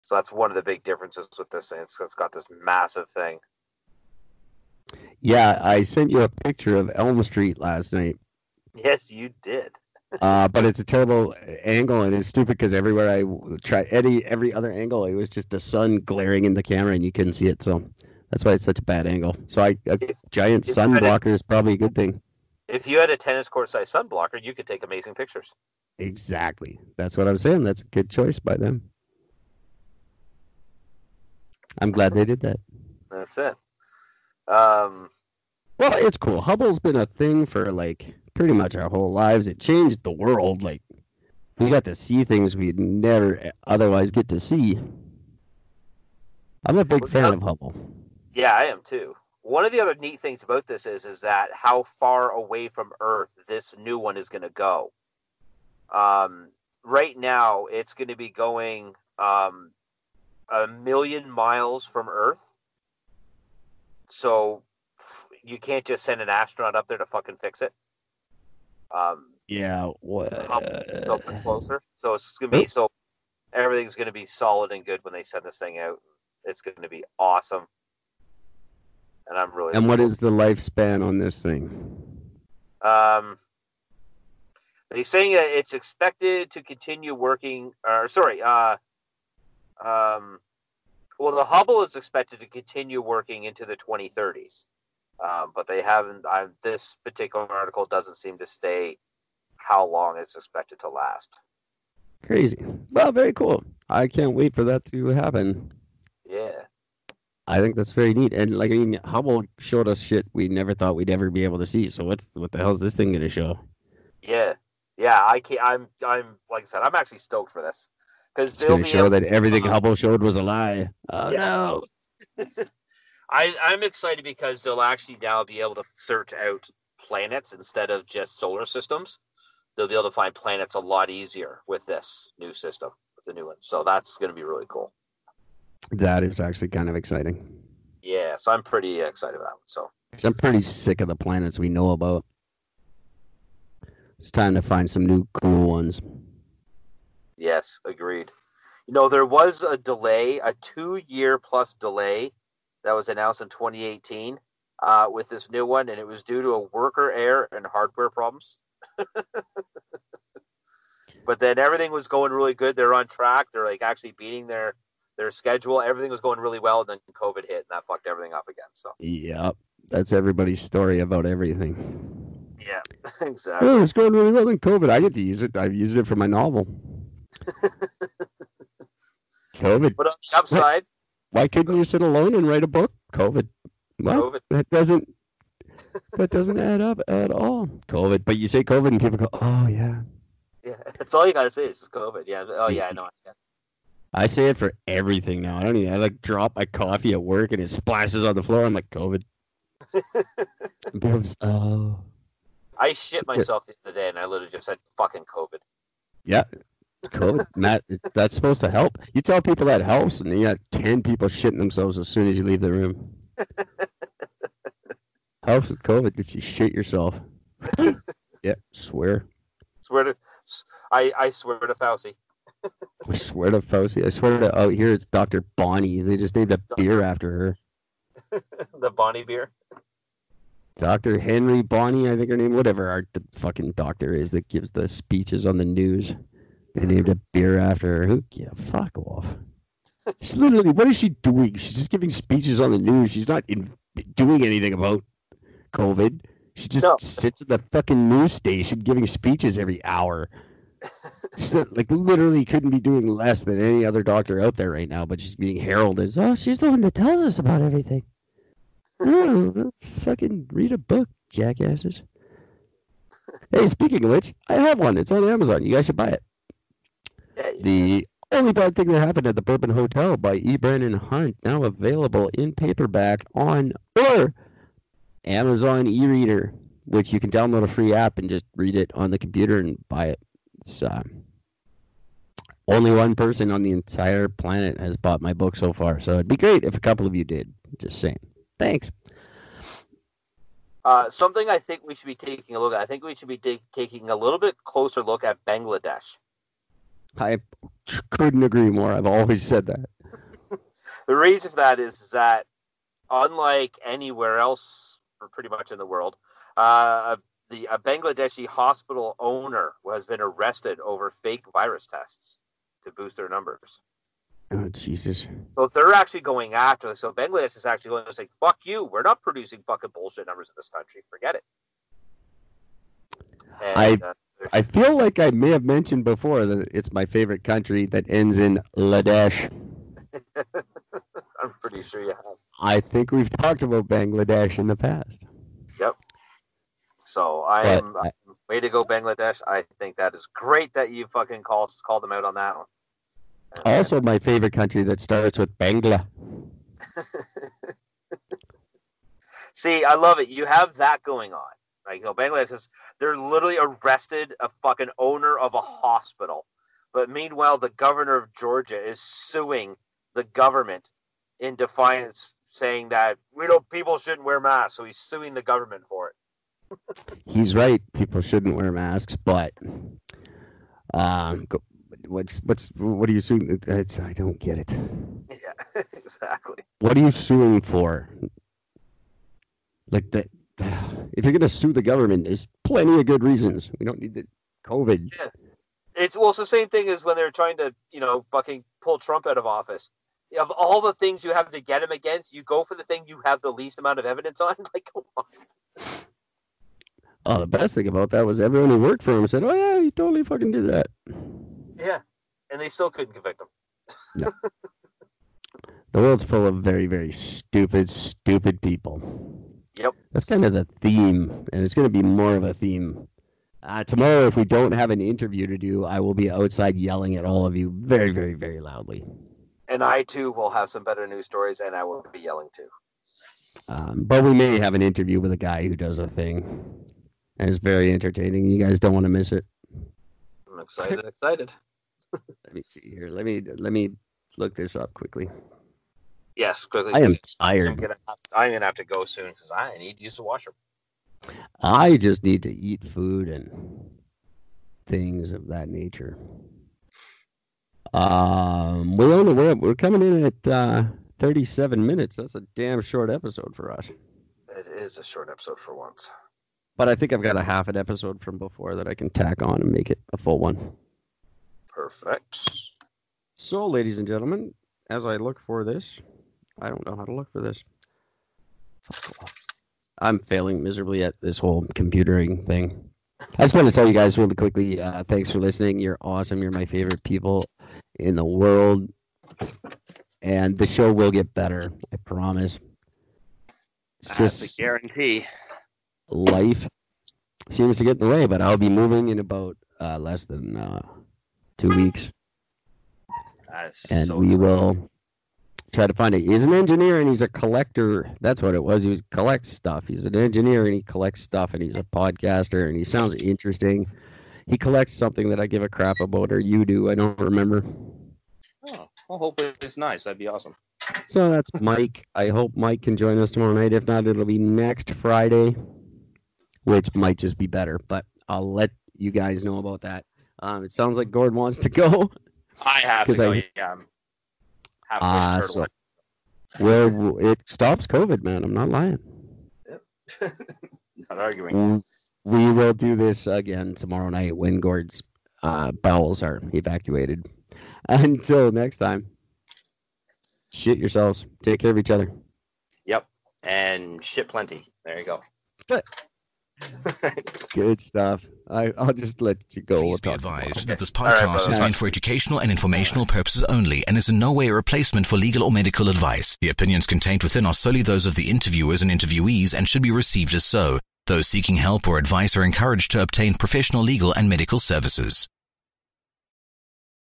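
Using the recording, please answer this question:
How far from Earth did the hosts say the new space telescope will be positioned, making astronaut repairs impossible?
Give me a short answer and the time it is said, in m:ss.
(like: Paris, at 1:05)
1,000,000 miles, at 1:00.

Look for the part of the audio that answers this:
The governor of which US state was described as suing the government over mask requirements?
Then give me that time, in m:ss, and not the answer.
5:58.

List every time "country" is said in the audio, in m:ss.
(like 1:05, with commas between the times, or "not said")
5:20, 5:27, 5:44.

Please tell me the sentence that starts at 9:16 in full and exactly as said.
The opinions contained within are solely those of the interviewers and interviewees and should be received as so.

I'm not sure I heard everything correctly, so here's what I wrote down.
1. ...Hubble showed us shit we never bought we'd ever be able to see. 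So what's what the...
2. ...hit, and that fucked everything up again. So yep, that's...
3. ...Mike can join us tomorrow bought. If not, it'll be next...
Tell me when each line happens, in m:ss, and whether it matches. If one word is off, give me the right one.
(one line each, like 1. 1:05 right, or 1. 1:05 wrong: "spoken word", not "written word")
1. 1:49 wrong: "thought", not "bought"
2. 2:47 right
3. 8:32 wrong: "night", not "bought".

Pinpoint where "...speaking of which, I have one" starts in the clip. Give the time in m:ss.
4:23.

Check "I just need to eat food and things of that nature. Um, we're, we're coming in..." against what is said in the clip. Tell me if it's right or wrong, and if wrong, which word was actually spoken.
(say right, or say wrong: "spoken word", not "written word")
right.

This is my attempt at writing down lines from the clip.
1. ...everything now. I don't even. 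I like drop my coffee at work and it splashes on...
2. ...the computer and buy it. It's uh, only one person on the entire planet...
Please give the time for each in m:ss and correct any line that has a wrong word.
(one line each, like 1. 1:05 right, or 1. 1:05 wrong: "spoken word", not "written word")
1. 3:14 right
2. 4:39 right.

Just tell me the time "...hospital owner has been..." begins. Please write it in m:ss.
5:08.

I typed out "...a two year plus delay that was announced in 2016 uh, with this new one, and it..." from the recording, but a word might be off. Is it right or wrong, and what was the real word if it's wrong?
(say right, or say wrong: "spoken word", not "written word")
wrong: "2018", not "2016".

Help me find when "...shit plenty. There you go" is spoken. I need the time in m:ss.
9:04.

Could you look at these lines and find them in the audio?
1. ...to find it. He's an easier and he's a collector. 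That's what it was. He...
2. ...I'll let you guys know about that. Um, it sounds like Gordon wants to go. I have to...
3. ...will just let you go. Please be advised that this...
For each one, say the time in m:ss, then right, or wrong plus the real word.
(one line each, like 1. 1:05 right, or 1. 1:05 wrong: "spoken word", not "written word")
1. 8:15 wrong: "engineer", not "easier"
2. 8:38 right
3. 9:08 right.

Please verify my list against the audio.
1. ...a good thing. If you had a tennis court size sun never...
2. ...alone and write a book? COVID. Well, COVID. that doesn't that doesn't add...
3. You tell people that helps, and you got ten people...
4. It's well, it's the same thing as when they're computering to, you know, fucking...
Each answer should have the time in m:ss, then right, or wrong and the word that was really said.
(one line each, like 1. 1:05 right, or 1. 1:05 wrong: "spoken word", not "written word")
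1. 0:21 wrong: "blocker", not "never"
2. 3:02 right
3. 3:29 right
4. 6:25 wrong: "trying", not "computering".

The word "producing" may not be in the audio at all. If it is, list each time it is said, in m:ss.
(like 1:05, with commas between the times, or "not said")
5:19.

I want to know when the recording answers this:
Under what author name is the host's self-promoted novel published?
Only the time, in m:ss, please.
4:30.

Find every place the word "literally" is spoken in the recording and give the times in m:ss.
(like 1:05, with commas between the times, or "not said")
3:24, 4:00, 4:11, 5:53.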